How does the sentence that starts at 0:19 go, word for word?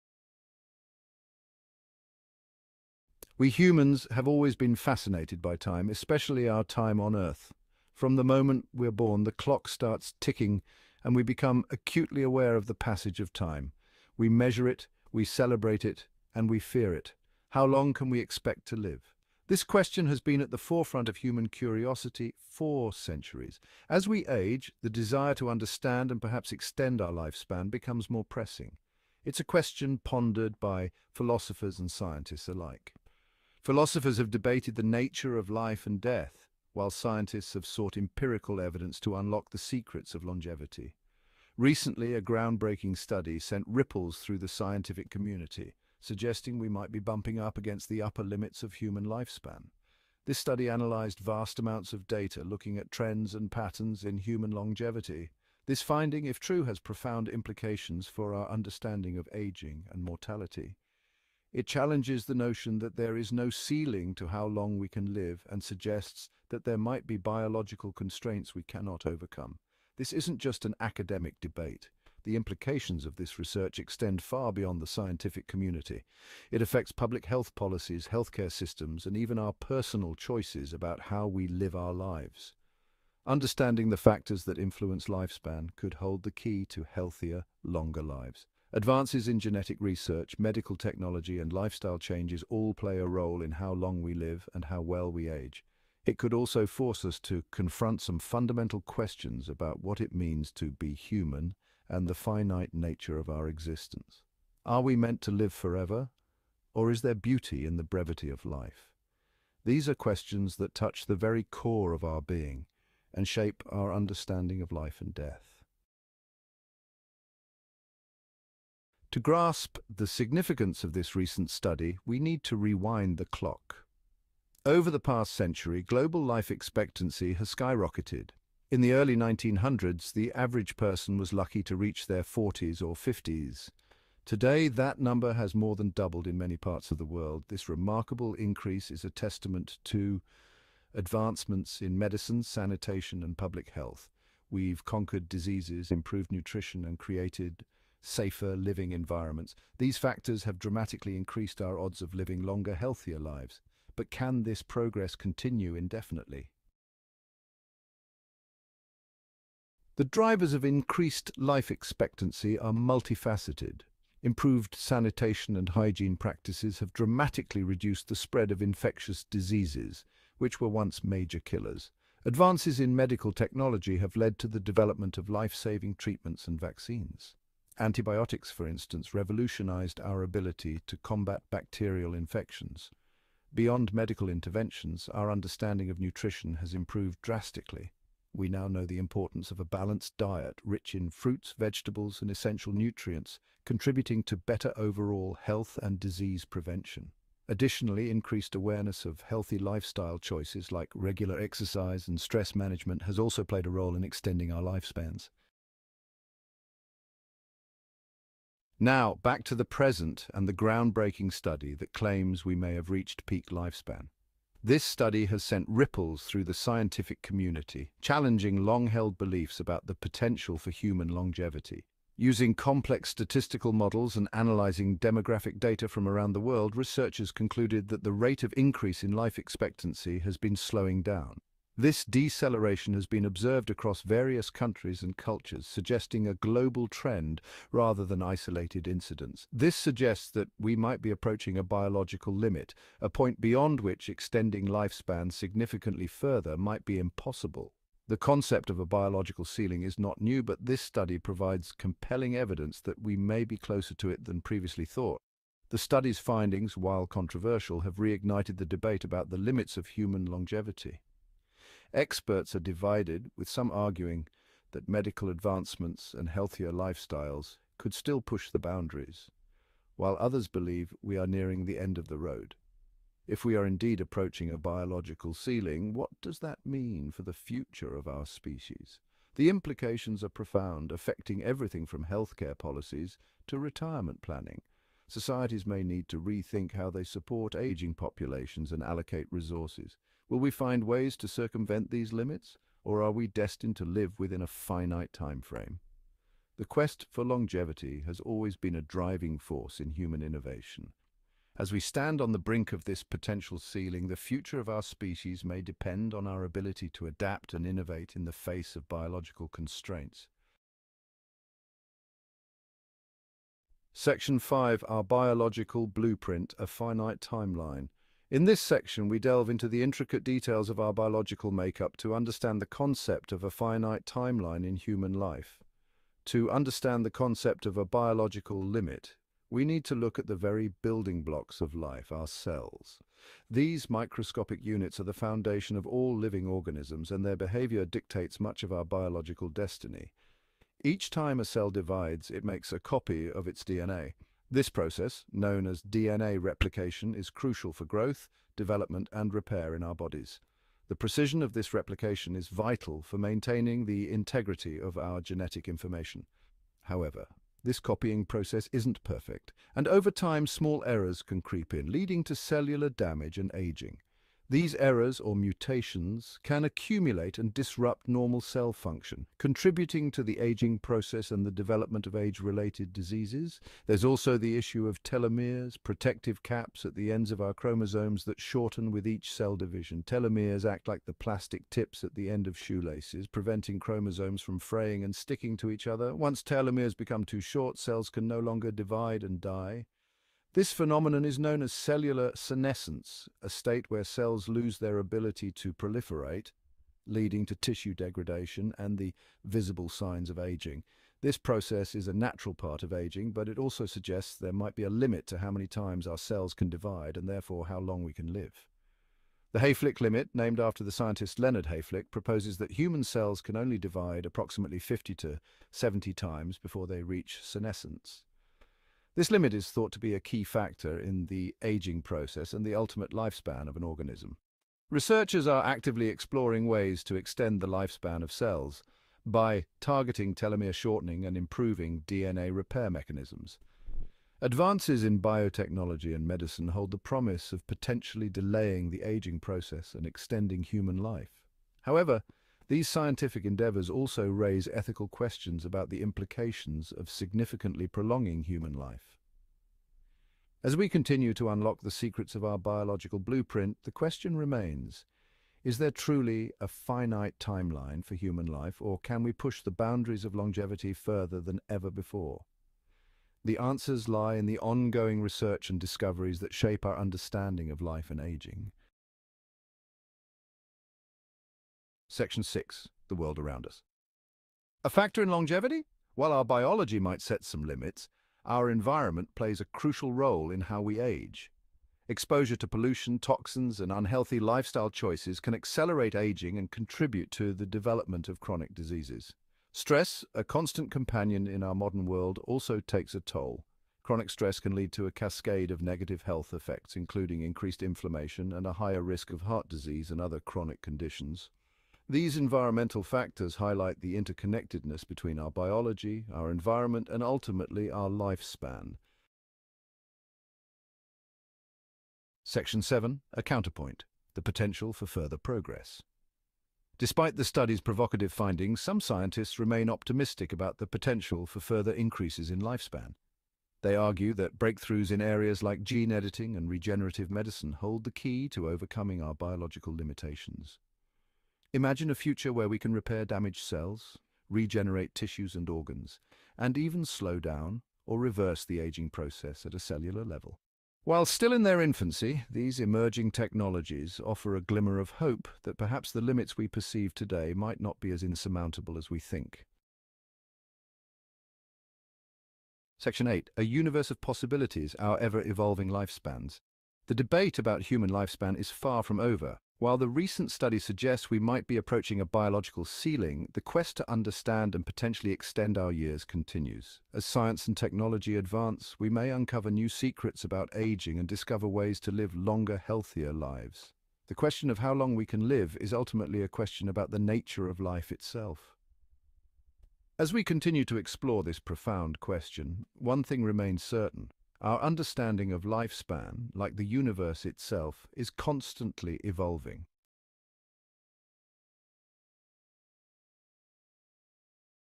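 This question has been at the forefront of human curiosity for centuries.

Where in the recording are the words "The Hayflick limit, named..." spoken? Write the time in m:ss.
6:49.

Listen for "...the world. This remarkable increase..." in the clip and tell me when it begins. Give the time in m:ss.
2:16.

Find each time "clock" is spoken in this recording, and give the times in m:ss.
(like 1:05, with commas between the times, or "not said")
0:09, 2:03.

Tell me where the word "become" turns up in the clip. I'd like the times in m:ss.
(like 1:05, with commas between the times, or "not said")
0:11, 0:27, 6:26.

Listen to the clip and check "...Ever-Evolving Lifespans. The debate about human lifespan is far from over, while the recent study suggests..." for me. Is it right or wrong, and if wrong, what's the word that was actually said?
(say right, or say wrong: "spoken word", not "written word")
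right.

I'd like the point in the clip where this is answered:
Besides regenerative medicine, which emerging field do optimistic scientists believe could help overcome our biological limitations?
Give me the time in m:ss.
8:45.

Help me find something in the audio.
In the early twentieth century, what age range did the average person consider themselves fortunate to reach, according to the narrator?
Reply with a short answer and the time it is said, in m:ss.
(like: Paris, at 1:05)
40s or 50s, at 2:12.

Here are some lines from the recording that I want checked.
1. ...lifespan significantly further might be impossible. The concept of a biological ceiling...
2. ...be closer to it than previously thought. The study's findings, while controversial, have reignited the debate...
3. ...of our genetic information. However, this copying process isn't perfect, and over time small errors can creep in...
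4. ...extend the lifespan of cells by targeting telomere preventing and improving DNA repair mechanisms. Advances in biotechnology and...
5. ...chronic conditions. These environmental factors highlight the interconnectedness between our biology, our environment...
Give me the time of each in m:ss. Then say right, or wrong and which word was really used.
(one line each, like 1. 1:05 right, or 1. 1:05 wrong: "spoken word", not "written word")
1. 4:04 right
2. 4:13 right
3. 5:54 right
4. 7:07 wrong: "shortening", not "preventing"
5. 8:20 right.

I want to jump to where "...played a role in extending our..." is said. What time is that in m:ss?
3:23.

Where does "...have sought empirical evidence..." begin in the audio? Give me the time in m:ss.
0:37.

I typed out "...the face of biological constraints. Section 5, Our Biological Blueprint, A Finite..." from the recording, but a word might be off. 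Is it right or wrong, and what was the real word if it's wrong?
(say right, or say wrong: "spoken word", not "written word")
right.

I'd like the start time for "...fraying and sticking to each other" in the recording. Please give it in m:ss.
6:24.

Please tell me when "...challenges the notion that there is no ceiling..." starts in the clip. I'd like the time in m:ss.
1:01.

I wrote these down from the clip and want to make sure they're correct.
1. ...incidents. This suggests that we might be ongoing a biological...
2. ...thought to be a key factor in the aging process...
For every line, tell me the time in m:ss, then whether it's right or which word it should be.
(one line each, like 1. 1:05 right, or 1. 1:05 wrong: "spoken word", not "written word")
1. 3:58 wrong: "approaching", not "ongoing"
2. 6:59 right.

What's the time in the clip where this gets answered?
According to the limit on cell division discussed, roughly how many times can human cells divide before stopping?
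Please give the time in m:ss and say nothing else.
6:54.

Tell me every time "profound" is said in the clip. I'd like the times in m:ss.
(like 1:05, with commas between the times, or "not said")
0:56, 4:40, 9:41.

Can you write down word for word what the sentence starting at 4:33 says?
If we are indeed approaching a biological ceiling, what does that mean for the future of our species?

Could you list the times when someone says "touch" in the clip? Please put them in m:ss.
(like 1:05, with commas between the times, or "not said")
1:50.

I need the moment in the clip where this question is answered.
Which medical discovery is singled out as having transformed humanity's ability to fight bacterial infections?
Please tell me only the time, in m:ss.
2:57.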